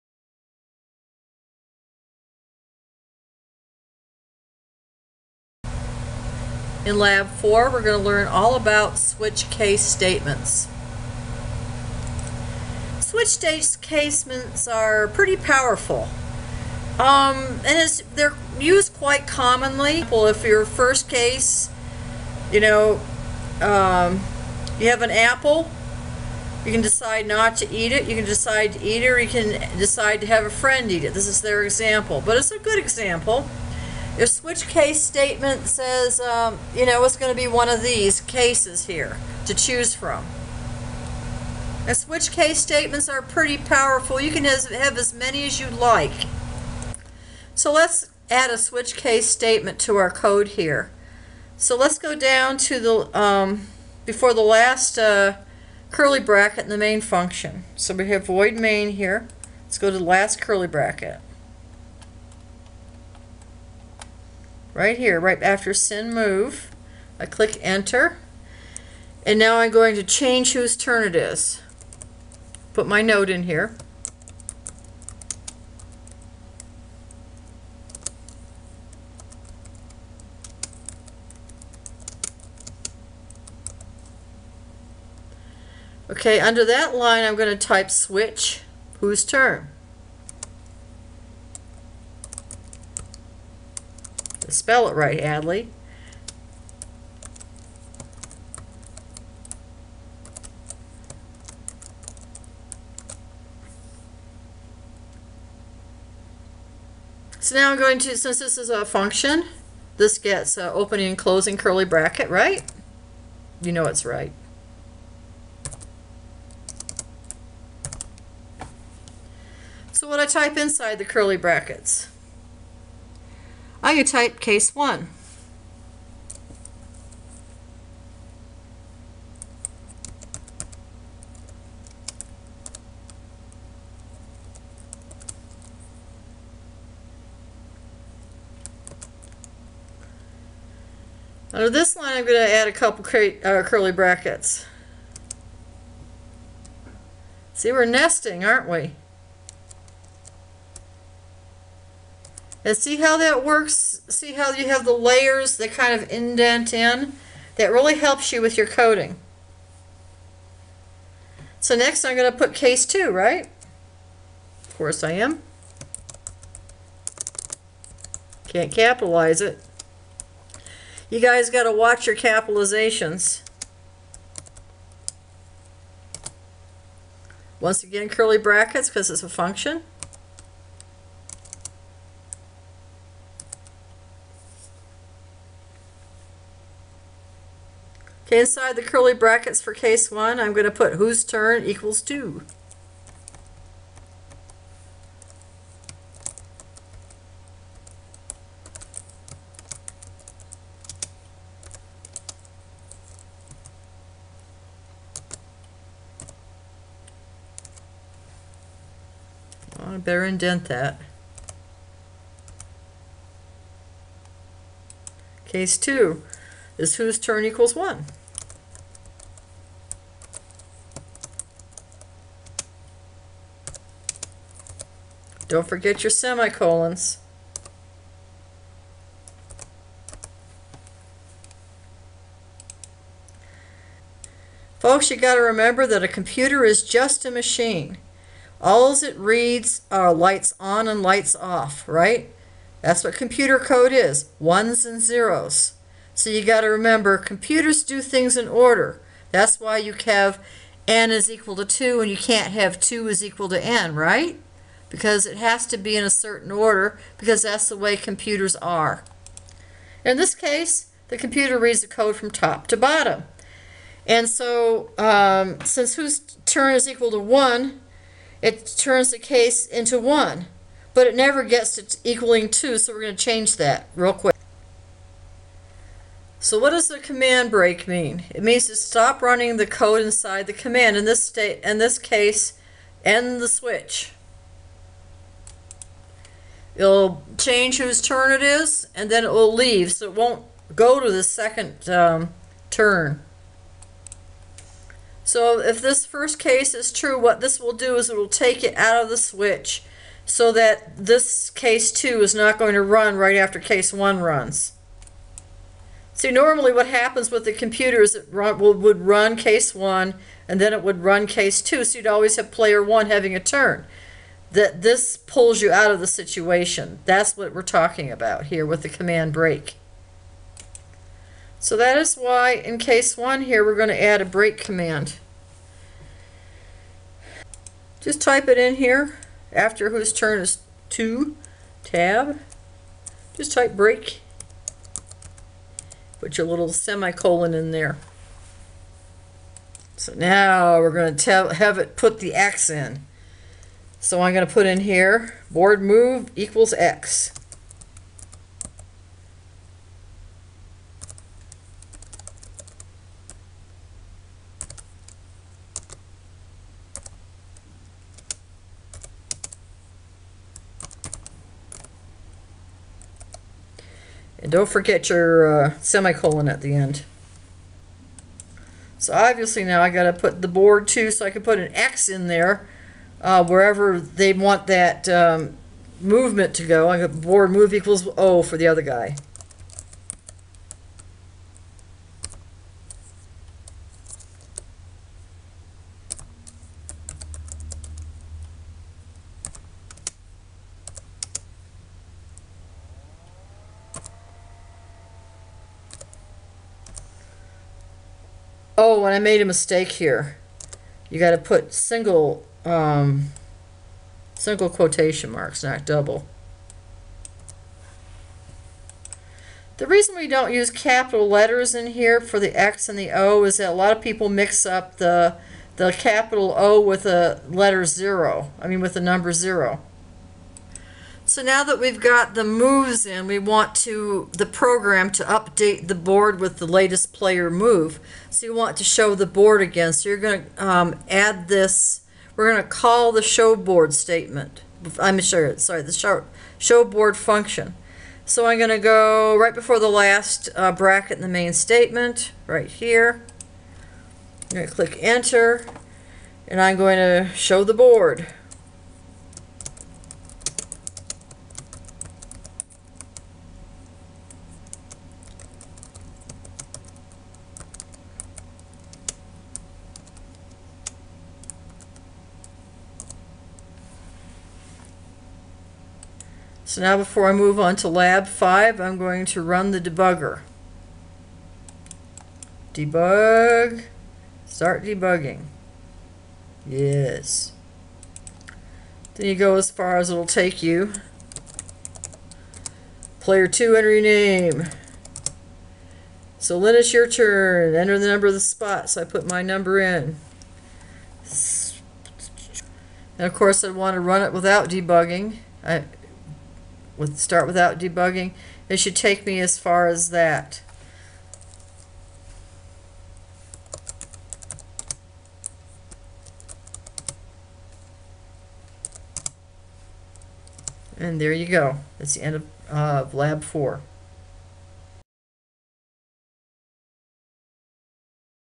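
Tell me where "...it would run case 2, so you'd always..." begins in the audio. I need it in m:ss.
5:10.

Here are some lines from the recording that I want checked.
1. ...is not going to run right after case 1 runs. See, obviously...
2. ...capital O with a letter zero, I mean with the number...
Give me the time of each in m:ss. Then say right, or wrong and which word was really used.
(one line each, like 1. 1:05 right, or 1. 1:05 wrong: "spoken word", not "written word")
1. 5:02 wrong: "normally", not "obviously"
2. 6:55 right.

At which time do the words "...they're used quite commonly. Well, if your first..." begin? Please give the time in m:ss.
0:18.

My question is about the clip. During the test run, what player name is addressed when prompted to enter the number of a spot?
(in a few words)
Lynn.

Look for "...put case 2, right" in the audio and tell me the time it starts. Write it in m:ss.
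2:42.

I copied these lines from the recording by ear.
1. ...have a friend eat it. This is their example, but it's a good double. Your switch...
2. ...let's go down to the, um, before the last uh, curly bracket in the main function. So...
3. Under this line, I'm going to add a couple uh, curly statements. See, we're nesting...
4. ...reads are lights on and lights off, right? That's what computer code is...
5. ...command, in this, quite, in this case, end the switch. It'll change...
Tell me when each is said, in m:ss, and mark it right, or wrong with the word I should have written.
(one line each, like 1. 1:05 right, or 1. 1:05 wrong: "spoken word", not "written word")
1. 0:30 wrong: "example", not "double"
2. 0:51 right
3. 2:21 wrong: "brackets", not "statements"
4. 3:59 right
5. 4:40 wrong: "state", not "quite".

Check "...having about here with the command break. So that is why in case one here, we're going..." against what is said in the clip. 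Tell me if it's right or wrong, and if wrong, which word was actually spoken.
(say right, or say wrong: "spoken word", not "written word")
wrong: "talking", not "having".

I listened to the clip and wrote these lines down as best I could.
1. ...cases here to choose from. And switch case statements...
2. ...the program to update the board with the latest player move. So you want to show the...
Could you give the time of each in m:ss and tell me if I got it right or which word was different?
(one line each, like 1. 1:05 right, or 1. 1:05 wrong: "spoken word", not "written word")
1. 0:38 right
2. 7:04 right.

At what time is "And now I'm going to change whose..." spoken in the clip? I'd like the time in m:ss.
1:09.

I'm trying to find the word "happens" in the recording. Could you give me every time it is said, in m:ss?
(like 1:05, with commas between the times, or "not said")
5:06.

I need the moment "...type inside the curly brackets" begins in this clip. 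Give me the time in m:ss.
2:00.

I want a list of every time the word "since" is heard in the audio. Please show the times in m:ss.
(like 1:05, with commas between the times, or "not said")
1:48, 4:25.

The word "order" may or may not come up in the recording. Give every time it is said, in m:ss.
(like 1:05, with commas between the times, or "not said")
4:08, 4:16.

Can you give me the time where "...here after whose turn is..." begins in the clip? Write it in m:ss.
5:28.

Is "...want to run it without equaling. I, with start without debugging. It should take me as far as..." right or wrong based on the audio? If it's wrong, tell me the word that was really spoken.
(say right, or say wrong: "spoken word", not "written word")
wrong: "debugging", not "equaling".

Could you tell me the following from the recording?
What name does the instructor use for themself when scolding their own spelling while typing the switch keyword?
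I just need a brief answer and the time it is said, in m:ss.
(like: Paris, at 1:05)
Adley, at 1:35.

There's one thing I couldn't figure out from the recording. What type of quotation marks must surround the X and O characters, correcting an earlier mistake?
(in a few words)
single quotation marks.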